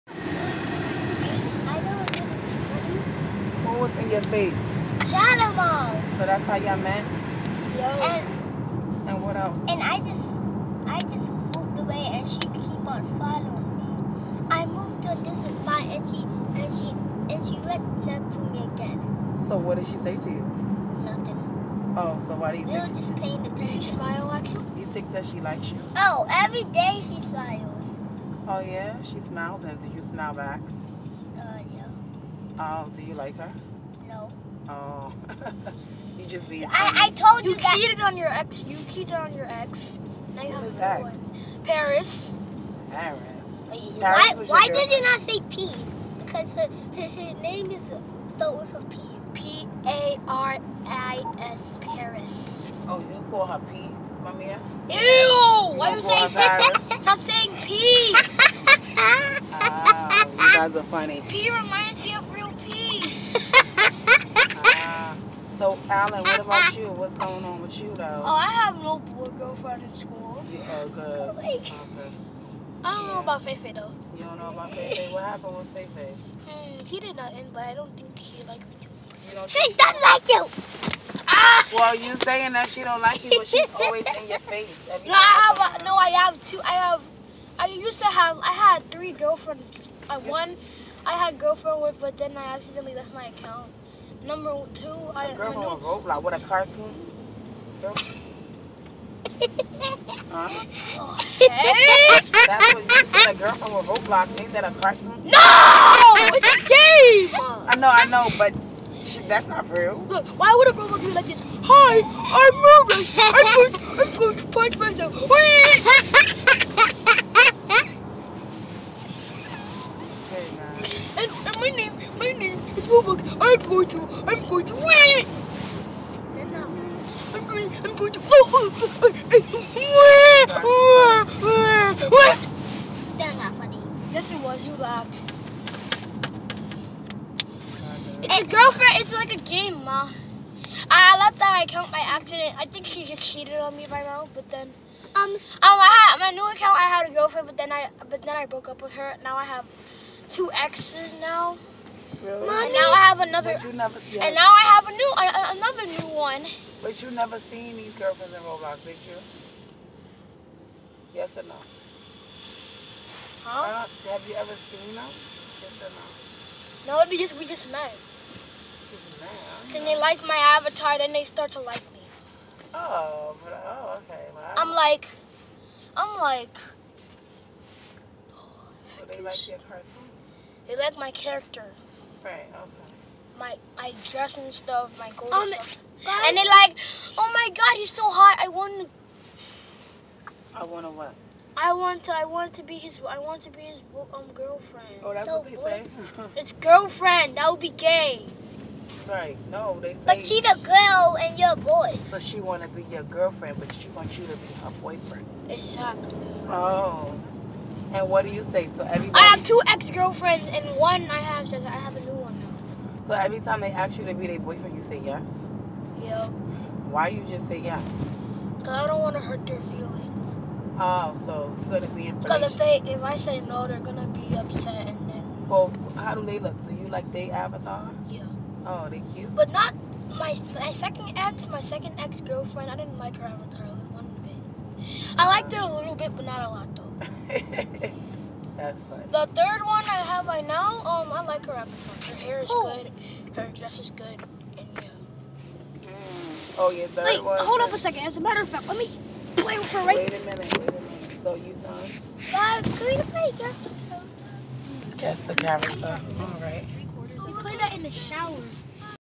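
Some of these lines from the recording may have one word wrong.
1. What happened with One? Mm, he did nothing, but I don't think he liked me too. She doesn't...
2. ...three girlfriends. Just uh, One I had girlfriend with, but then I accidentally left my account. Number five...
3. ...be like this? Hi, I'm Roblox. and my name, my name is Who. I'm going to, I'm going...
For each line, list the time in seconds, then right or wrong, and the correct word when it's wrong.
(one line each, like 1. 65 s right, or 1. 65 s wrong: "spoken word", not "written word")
1. 75 s wrong: "Fefe", not "One"
2. 88 s wrong: "two", not "five"
3. 111 s wrong: "Roblox", not "Who".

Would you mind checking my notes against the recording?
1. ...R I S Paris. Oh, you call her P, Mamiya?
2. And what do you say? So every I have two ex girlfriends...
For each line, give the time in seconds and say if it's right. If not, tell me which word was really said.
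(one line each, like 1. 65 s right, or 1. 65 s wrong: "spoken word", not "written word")
1. 50 s right
2. 207 s right.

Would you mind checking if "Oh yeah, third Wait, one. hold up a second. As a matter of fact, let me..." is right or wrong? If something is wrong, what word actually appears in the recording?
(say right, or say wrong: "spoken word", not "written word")
right.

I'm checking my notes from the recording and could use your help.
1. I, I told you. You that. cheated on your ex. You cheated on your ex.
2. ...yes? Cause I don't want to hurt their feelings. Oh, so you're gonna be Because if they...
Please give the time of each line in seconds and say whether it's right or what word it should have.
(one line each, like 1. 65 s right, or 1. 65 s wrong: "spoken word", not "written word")
1. 36 s right
2. 217 s right.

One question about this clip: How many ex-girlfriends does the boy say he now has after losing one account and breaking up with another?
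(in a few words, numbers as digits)
2.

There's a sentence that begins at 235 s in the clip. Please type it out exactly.
I liked it a little bit, but not a lot.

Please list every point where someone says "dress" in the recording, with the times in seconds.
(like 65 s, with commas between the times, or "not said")
184 s, 243 s.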